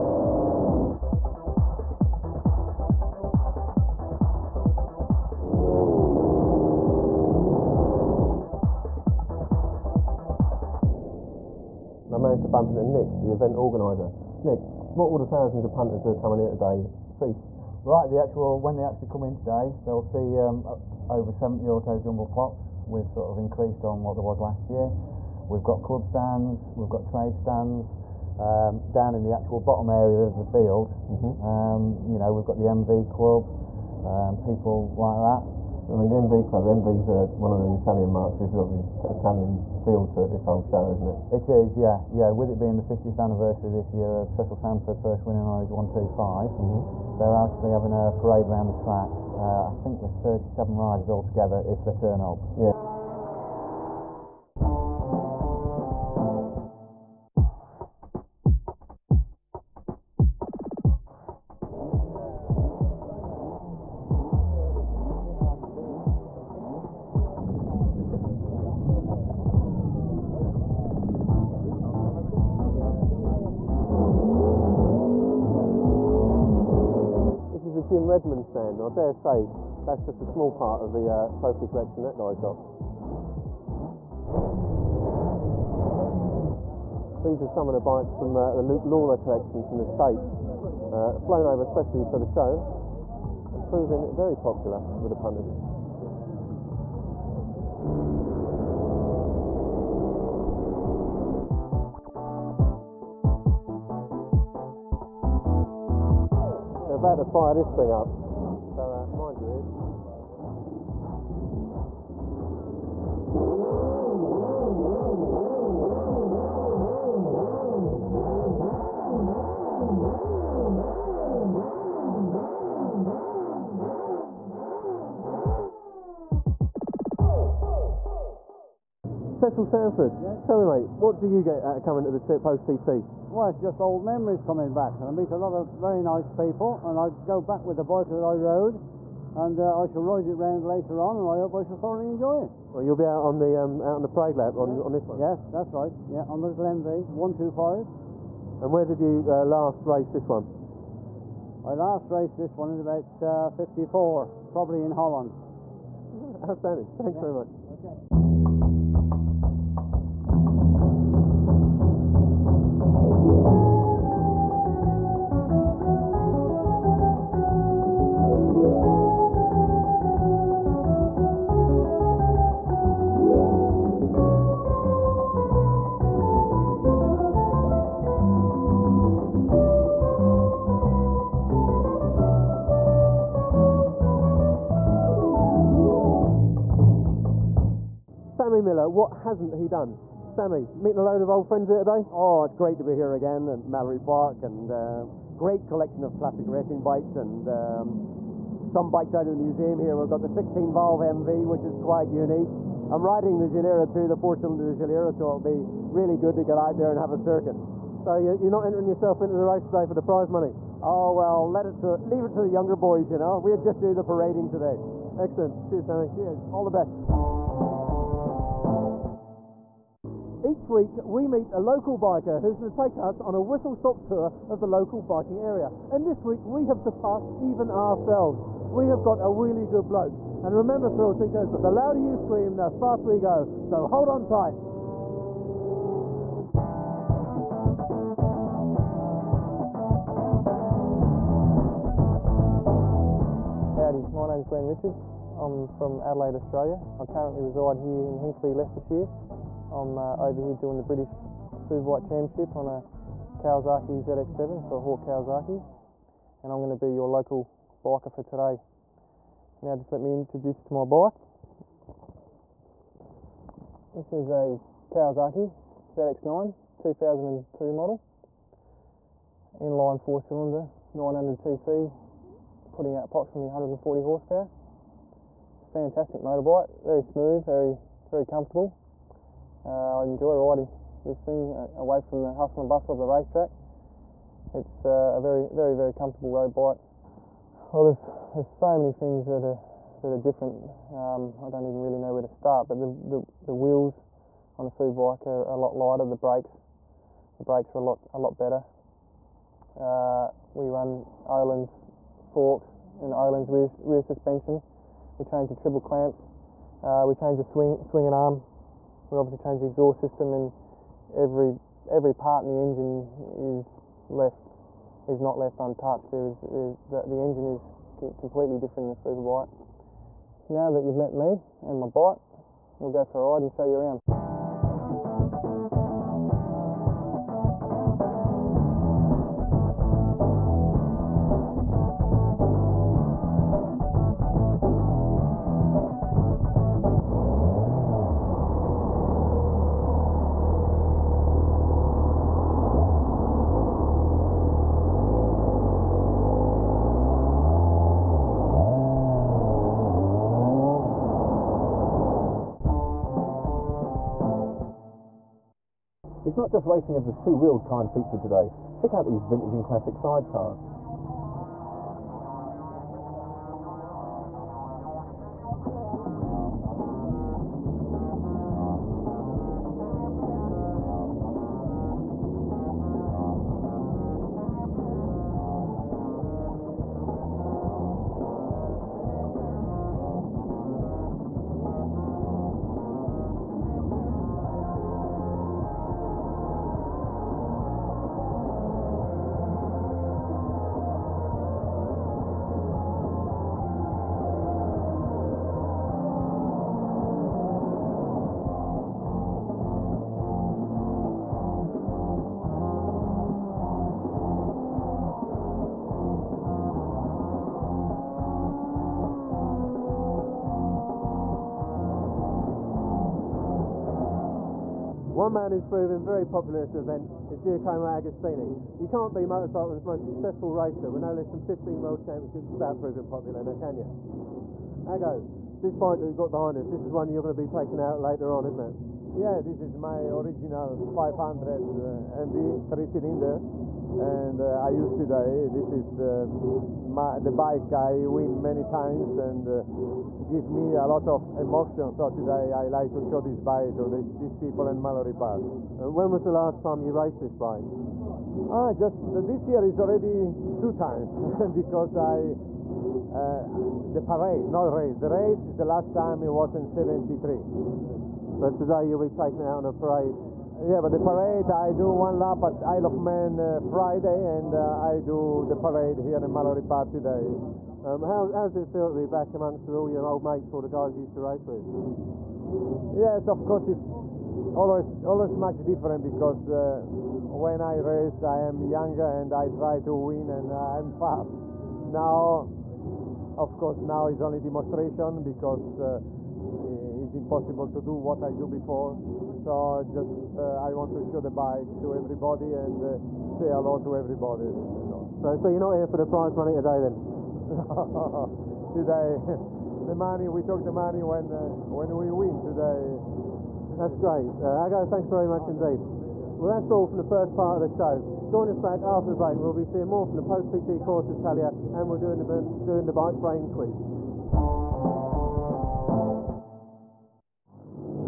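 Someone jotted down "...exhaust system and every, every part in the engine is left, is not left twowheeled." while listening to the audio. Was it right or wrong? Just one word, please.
wrong.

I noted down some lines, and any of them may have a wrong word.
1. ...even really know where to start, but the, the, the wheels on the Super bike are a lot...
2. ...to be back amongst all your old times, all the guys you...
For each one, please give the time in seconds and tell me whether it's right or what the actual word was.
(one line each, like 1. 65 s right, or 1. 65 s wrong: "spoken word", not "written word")
1. 291 s right
2. 468 s wrong: "mates", not "times".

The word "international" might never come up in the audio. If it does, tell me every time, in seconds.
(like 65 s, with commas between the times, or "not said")
not said.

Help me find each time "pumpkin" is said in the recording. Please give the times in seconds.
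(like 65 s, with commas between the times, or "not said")
not said.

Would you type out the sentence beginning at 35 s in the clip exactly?
So, I mean, the MV Club, the MV's uh, one of the Italian marks.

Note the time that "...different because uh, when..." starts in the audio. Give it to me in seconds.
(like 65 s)
475 s.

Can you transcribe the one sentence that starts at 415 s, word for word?
One man who's proven very popular at this event is Giacomo Agostini.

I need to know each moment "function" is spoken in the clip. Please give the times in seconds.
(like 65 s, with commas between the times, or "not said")
not said.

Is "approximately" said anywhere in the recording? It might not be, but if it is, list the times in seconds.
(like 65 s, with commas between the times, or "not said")
273 s.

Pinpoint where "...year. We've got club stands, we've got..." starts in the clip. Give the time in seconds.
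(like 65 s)
24 s.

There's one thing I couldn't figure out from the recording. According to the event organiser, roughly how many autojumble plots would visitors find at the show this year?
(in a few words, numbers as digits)
over 70.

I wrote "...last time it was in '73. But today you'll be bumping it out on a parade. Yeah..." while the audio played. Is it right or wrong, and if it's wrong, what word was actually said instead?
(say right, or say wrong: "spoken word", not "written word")
wrong: "taking", not "bumping".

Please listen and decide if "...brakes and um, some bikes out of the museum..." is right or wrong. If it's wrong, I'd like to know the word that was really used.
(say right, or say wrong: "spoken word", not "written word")
wrong: "bikes", not "brakes".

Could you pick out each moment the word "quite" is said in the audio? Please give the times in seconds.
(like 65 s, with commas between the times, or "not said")
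201 s.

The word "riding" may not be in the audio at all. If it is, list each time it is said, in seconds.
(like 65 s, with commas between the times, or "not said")
203 s, 280 s.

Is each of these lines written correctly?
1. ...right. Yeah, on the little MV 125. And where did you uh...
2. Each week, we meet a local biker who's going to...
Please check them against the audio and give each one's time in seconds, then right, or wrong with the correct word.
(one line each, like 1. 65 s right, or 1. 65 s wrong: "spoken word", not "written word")
1. 145 s right
2. 220 s right.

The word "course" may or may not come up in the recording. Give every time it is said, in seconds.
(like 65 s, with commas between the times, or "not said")
473 s, 483 s, 510 s.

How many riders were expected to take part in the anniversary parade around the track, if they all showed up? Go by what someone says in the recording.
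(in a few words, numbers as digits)
37.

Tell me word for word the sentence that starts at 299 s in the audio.
Uh, we run Öhlins forks and Öhlins rear, rear suspension.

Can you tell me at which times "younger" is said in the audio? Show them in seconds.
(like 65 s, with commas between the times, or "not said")
212 s, 478 s.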